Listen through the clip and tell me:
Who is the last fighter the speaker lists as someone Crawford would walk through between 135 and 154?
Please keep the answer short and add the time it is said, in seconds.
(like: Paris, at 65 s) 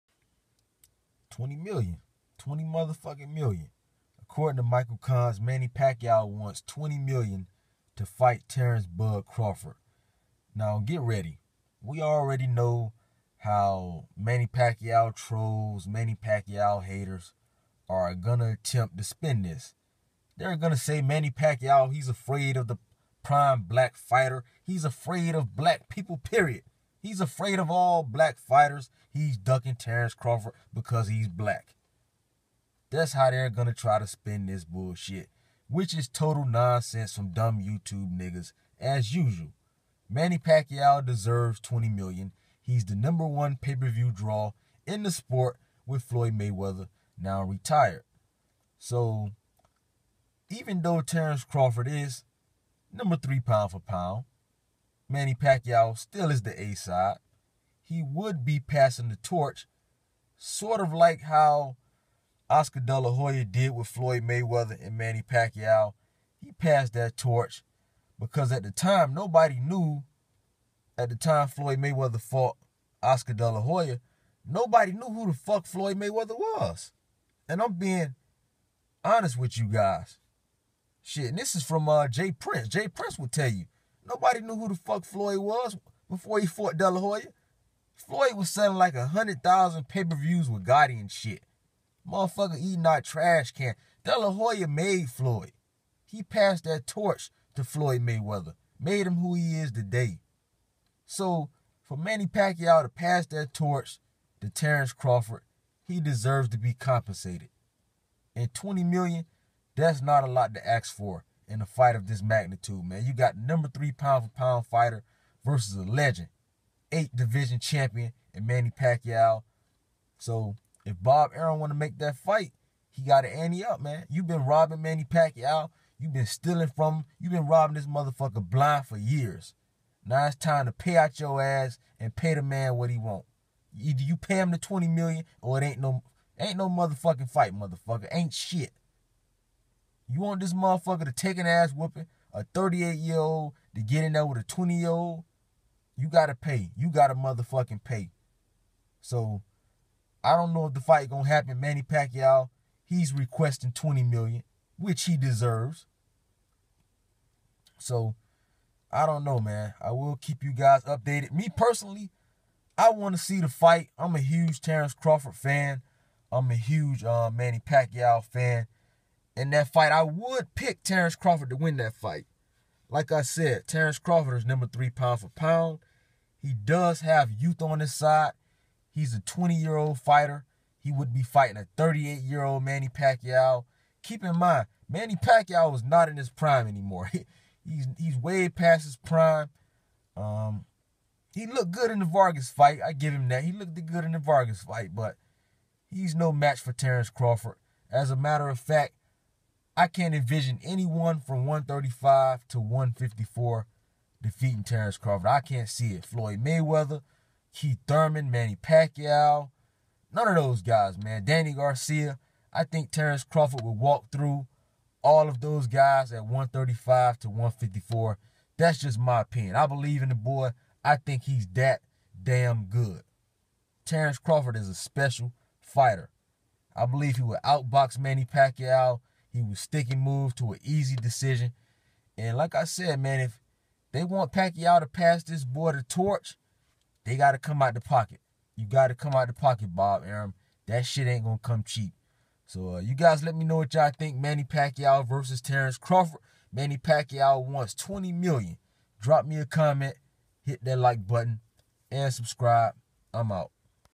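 Danny Garcia, at 211 s.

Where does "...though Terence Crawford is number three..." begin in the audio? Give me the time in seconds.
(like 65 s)
50 s.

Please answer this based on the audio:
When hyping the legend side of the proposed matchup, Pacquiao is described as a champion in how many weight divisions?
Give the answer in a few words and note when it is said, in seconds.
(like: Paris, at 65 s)
8, at 116 s.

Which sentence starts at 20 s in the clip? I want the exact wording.
They're gonna say Manny Pacquiao, he's afraid of the prime black fighter.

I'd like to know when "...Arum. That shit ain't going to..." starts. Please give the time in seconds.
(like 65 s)
240 s.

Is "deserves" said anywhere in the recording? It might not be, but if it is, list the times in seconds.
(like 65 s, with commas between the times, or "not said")
41 s, 106 s, 155 s.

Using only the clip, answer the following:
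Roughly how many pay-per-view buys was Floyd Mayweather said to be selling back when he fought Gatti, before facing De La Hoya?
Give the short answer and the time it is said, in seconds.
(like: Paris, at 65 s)
100,000, at 88 s.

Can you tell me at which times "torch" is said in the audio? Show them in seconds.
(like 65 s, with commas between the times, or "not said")
59 s, 67 s, 96 s, 103 s, 235 s.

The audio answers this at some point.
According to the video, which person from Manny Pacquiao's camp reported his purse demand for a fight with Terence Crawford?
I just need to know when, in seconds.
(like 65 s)
4 s.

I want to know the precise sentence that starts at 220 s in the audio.
I think he's that damn good.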